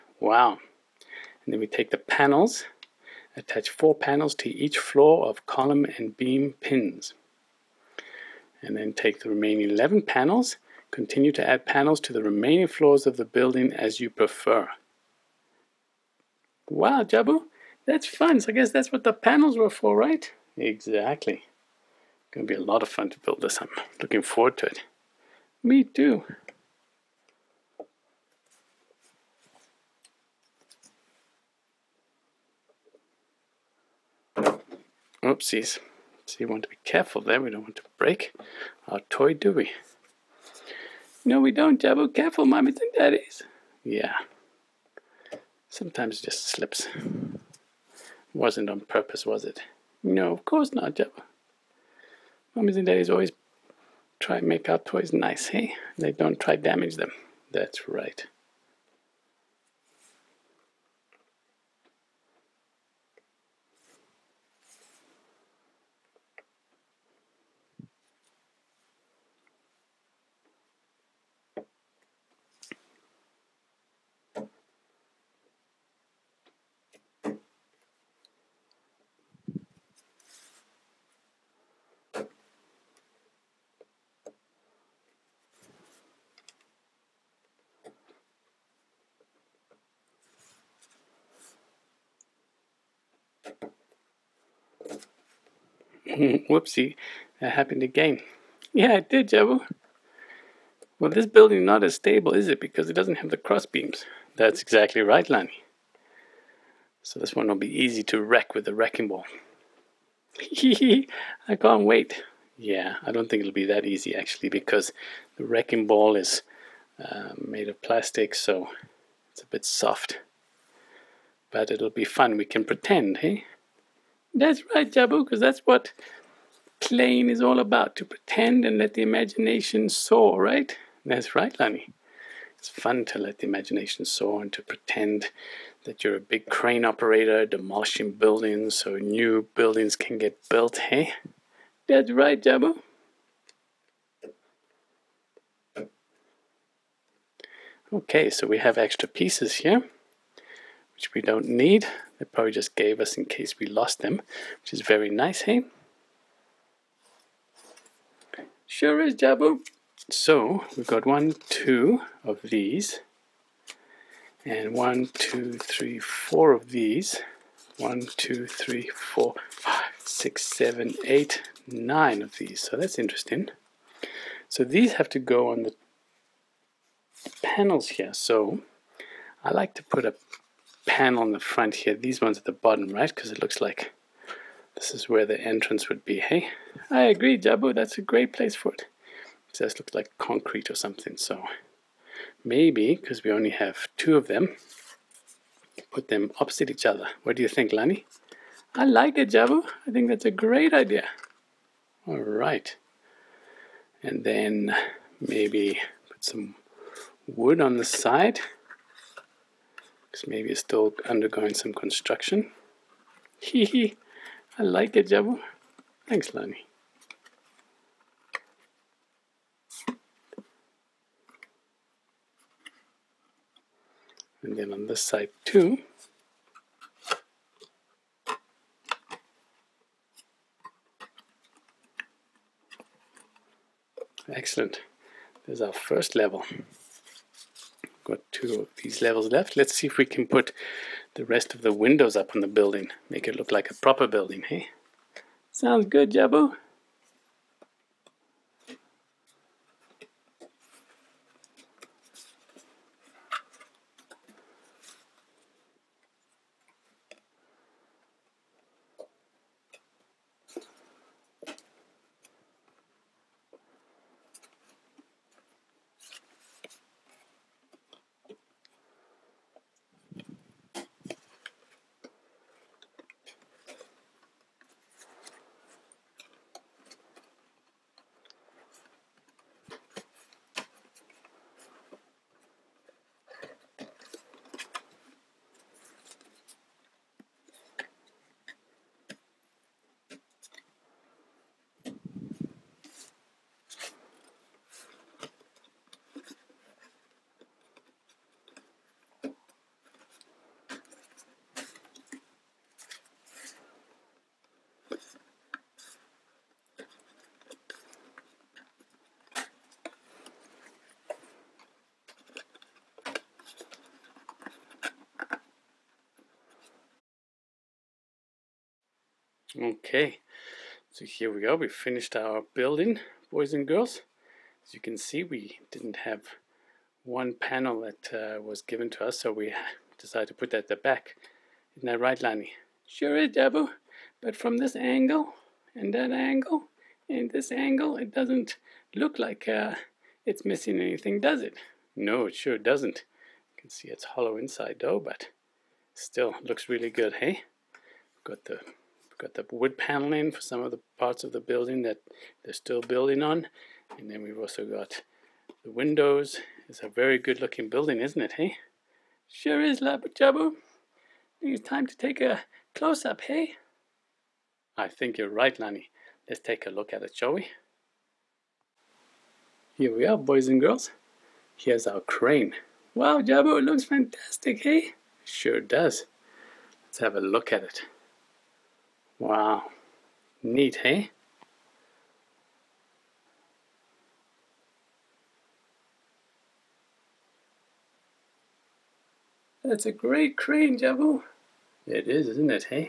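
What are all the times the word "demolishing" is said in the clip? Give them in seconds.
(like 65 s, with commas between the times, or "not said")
137 s.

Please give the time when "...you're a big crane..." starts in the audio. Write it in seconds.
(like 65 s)
136 s.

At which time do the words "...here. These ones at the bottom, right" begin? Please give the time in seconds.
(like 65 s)
181 s.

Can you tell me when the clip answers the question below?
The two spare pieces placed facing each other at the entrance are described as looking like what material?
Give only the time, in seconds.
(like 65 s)
190 s.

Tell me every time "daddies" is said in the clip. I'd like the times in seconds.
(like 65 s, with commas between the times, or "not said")
42 s, 52 s.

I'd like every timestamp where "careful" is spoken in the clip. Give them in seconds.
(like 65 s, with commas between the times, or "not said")
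36 s, 42 s.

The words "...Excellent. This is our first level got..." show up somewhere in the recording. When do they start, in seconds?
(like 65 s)
234 s.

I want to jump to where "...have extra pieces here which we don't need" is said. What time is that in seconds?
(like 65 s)
148 s.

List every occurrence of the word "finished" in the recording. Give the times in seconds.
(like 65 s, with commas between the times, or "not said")
321 s.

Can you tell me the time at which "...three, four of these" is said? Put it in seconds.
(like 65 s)
165 s.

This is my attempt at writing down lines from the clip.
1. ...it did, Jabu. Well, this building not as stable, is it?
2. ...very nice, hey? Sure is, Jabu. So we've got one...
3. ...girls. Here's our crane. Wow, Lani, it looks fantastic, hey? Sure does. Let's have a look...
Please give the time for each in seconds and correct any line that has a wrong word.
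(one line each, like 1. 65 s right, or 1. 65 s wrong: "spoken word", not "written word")
1. 98 s right
2. 154 s right
3. 370 s wrong: "Jabu", not "Lani".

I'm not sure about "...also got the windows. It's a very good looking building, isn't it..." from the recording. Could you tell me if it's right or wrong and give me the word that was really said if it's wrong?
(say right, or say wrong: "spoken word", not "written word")
right.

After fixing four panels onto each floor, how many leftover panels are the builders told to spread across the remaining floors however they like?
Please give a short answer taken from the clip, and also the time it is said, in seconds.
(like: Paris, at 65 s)
11, at 9 s.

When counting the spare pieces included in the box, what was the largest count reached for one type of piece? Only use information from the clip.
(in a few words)
9.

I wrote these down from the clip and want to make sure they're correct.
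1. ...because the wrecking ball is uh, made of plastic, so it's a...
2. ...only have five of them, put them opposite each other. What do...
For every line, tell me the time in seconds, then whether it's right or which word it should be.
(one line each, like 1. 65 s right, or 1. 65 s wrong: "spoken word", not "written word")
1. 114 s right
2. 193 s wrong: "two", not "five".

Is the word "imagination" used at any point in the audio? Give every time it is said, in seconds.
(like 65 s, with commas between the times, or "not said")
129 s, 133 s.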